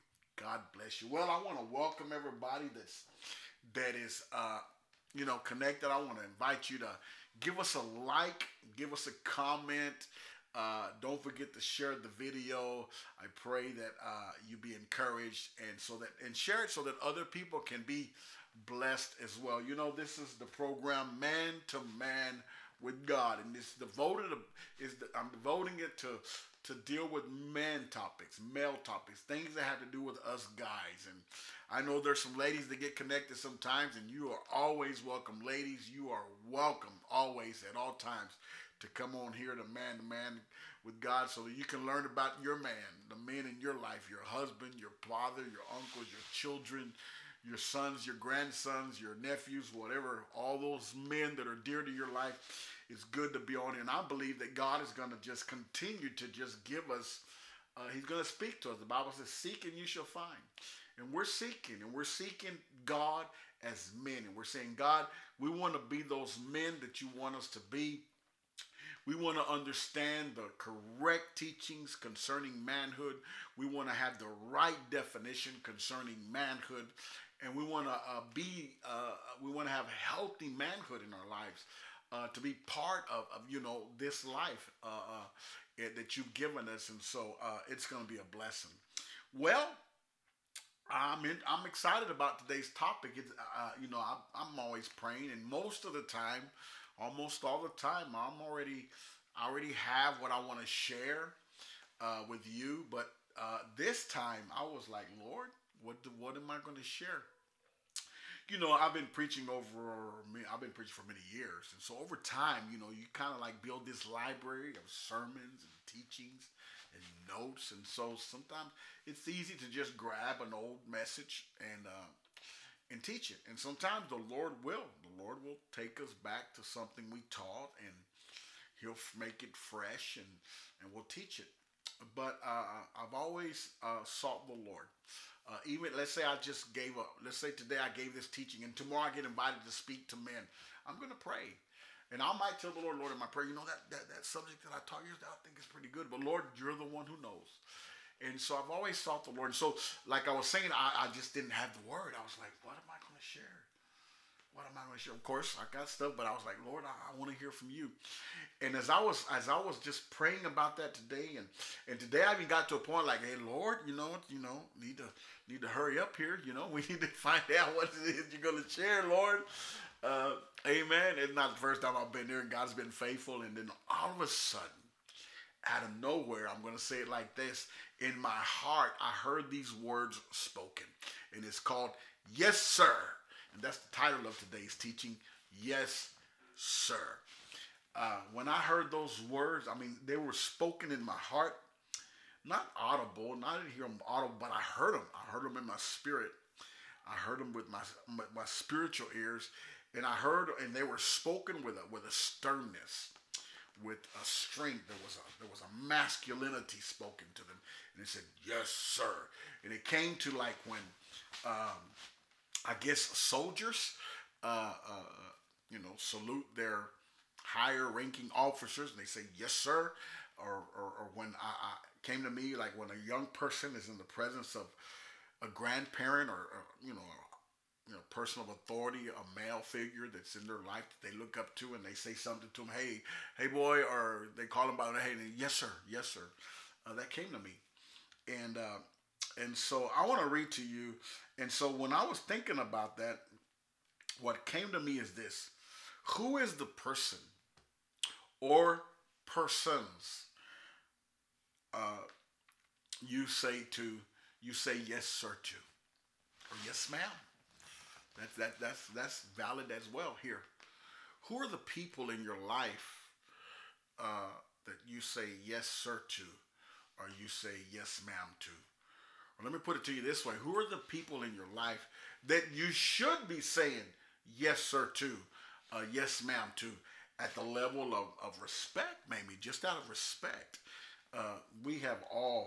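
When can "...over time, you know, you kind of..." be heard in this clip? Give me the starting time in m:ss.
1:52.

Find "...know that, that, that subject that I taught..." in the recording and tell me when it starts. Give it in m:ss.
2:23.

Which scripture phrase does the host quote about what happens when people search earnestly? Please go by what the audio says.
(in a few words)
Seek and you shall find.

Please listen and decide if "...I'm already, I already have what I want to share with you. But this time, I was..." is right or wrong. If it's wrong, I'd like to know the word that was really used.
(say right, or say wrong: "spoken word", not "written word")
right.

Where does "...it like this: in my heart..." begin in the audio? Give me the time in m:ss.
2:56.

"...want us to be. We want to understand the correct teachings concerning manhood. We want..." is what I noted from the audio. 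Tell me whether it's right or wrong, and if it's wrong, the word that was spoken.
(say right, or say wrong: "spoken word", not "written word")
right.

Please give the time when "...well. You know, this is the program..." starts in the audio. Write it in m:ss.
0:19.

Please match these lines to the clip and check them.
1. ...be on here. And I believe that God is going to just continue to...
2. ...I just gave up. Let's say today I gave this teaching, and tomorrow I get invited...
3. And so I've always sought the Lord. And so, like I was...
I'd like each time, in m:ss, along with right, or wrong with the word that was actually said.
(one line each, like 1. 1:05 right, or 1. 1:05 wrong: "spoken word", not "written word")
1. 0:53 right
2. 2:16 right
3. 2:28 right.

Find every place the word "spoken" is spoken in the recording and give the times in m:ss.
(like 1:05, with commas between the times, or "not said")
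3:00, 3:10, 3:20, 3:26.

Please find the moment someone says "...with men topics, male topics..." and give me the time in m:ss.
0:27.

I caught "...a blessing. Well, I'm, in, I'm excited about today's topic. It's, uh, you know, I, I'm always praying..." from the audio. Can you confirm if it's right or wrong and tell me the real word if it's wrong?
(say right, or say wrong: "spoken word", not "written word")
right.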